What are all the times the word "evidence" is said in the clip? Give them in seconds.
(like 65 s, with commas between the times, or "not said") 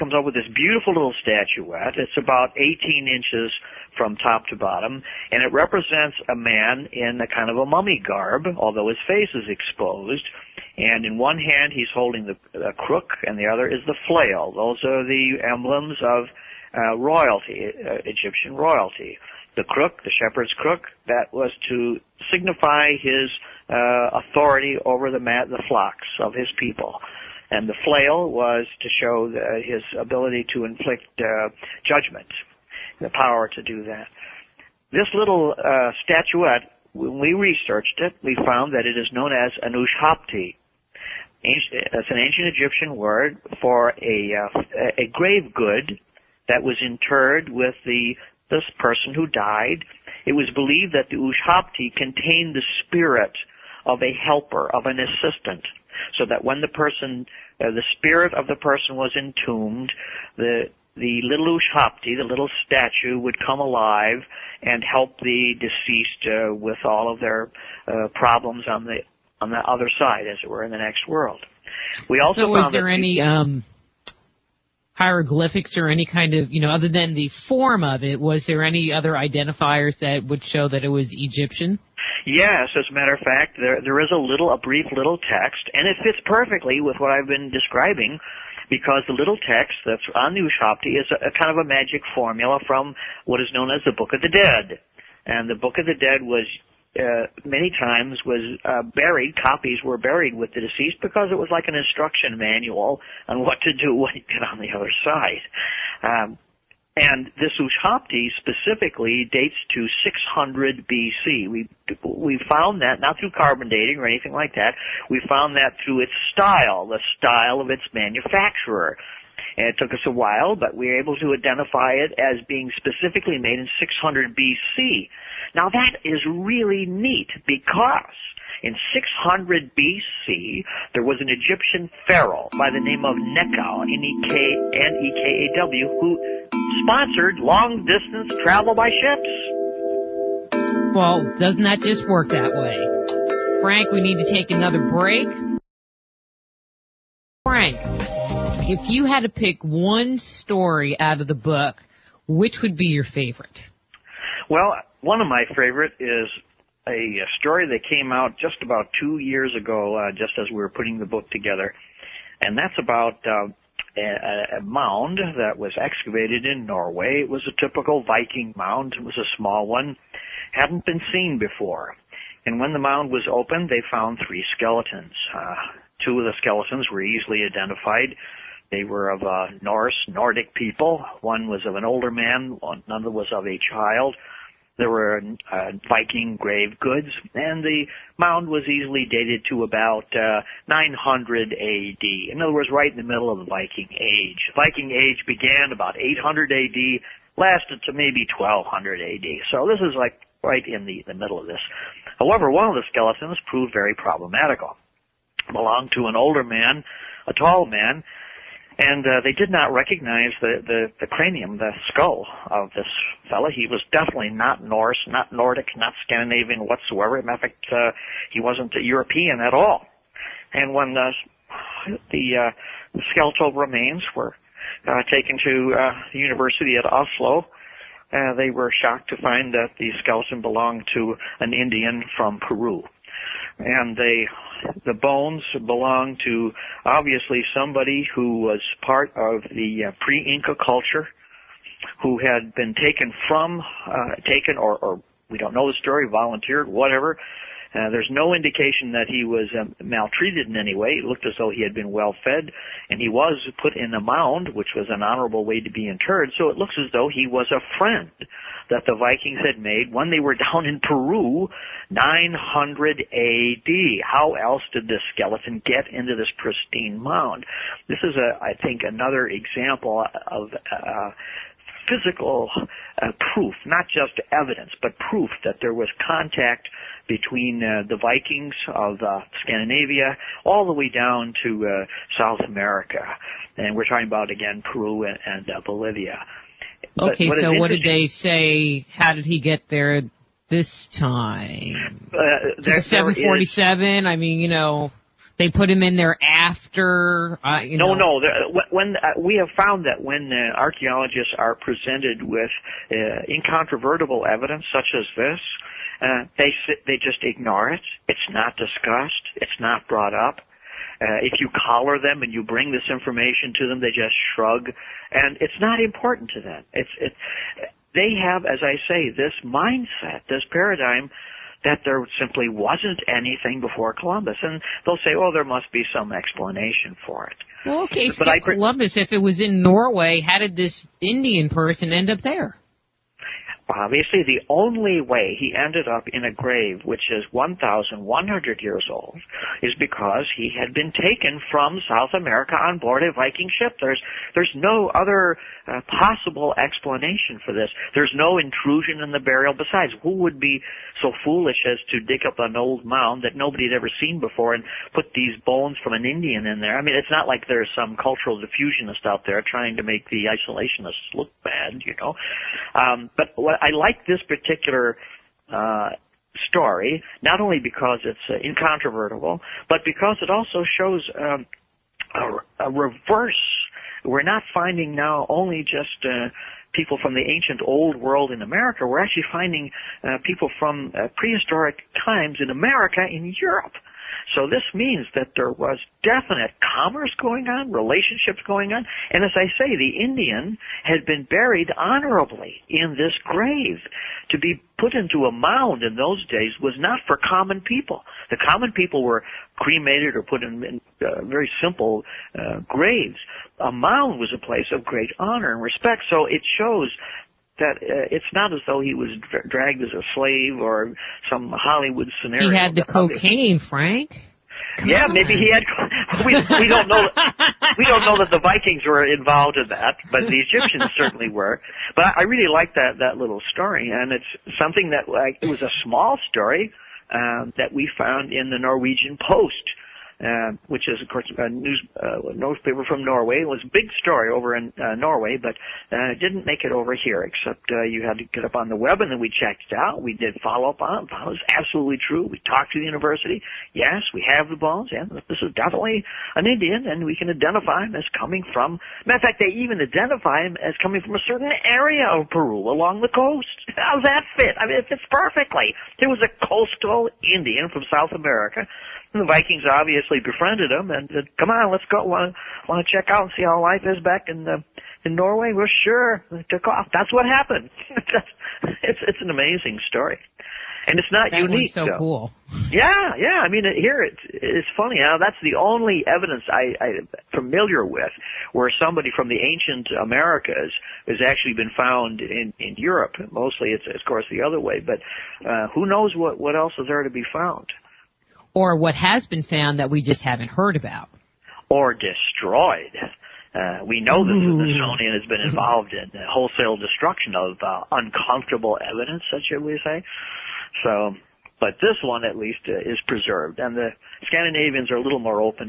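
274 s, 304 s, 476 s, 498 s.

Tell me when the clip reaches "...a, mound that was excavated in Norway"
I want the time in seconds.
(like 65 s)
164 s.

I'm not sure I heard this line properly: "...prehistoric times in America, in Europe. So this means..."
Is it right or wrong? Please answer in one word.
right.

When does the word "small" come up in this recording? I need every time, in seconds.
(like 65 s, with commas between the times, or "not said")
169 s, 425 s.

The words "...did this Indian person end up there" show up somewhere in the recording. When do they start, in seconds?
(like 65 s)
330 s.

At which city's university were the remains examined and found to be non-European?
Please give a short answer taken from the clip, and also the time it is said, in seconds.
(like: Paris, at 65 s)
Oslo, at 226 s.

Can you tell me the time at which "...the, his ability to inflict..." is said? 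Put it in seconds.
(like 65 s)
29 s.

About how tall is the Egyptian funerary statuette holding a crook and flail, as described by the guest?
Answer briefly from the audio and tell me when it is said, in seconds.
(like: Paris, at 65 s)
18 inches, at 2 s.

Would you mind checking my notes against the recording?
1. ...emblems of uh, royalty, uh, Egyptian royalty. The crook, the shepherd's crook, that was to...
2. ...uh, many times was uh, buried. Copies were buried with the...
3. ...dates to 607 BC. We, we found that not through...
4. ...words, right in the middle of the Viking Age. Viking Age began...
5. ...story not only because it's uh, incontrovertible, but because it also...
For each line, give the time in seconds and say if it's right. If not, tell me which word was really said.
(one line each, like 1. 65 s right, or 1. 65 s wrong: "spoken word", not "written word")
1. 15 s right
2. 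96 s right
3. 109 s wrong: "600", not "607"
4. 192 s right
5. 366 s right.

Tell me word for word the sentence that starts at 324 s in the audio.
And they'll say, oh, there must be some explanation for it.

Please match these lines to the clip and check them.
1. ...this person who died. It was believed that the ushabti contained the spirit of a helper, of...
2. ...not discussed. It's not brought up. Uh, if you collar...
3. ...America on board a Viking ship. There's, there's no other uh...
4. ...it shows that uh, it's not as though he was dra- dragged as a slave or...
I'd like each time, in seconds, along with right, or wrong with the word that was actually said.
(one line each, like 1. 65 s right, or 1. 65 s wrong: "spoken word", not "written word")
1. 48 s right
2. 308 s right
3. 342 s right
4. 406 s right.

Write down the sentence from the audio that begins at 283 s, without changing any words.
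And we're talking about, again, Peru and, and uh, Bolivia.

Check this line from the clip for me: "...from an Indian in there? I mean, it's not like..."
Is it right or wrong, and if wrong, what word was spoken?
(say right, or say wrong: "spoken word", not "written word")
right.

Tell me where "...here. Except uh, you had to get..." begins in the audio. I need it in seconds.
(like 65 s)
436 s.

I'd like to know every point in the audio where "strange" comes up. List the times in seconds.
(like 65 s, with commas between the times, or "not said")
not said.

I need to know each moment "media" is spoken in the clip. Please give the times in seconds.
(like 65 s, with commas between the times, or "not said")
not said.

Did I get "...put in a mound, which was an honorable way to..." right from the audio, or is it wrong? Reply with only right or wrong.
right.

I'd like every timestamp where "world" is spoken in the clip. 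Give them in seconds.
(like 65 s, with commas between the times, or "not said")
71 s, 377 s.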